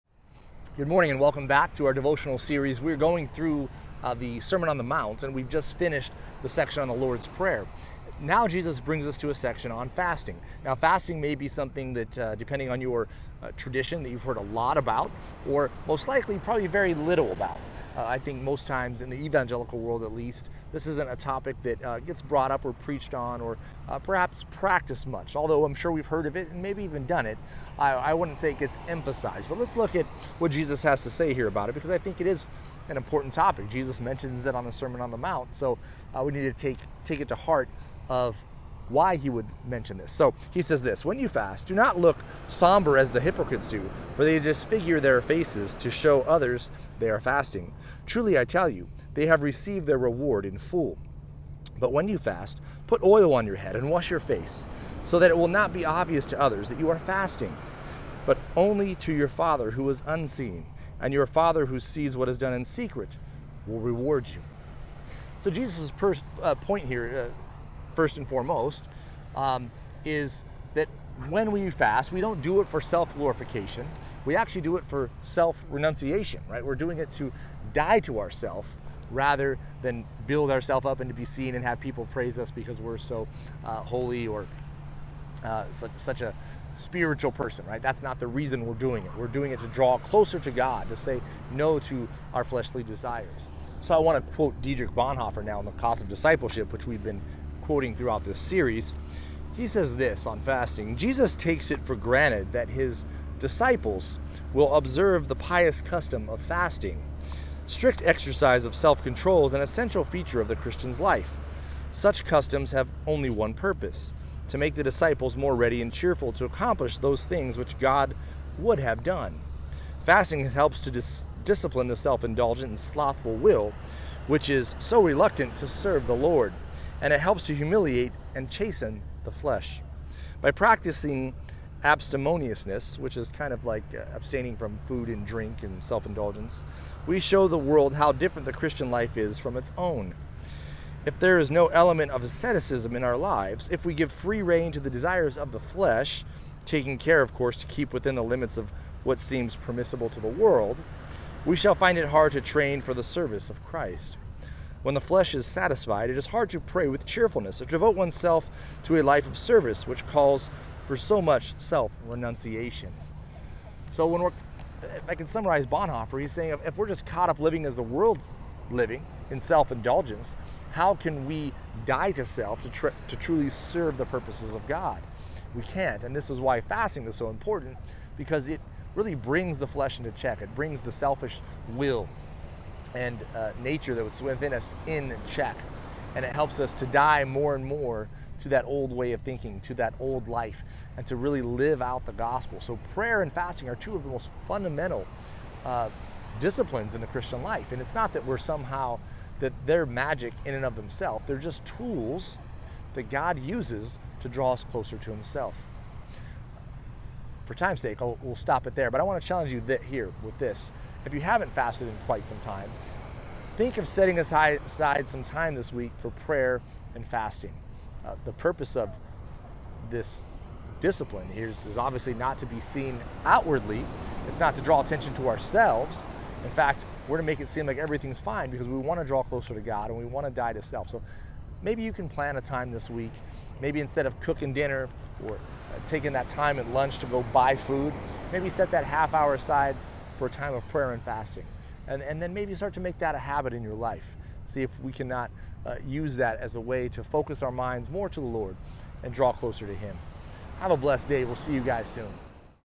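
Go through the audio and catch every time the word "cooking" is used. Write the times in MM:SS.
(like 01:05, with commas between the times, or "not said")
03:54.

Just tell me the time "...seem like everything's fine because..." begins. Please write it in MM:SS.
03:47.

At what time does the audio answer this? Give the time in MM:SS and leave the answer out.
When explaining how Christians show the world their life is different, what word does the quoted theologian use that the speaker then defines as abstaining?
02:11.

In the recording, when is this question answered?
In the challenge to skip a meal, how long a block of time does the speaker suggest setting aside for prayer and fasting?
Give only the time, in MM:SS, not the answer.
03:58.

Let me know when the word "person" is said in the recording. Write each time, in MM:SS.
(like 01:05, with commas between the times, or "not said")
01:27.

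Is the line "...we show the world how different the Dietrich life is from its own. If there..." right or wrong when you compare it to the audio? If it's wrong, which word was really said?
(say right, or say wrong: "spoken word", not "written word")
wrong: "Christian", not "Dietrich".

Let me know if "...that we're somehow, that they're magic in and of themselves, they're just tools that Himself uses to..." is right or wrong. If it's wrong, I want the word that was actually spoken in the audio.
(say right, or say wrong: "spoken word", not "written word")
wrong: "God", not "Himself".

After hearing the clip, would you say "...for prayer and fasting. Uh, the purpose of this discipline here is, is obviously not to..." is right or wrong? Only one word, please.
right.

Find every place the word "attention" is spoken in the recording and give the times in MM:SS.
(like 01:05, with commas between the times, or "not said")
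03:44.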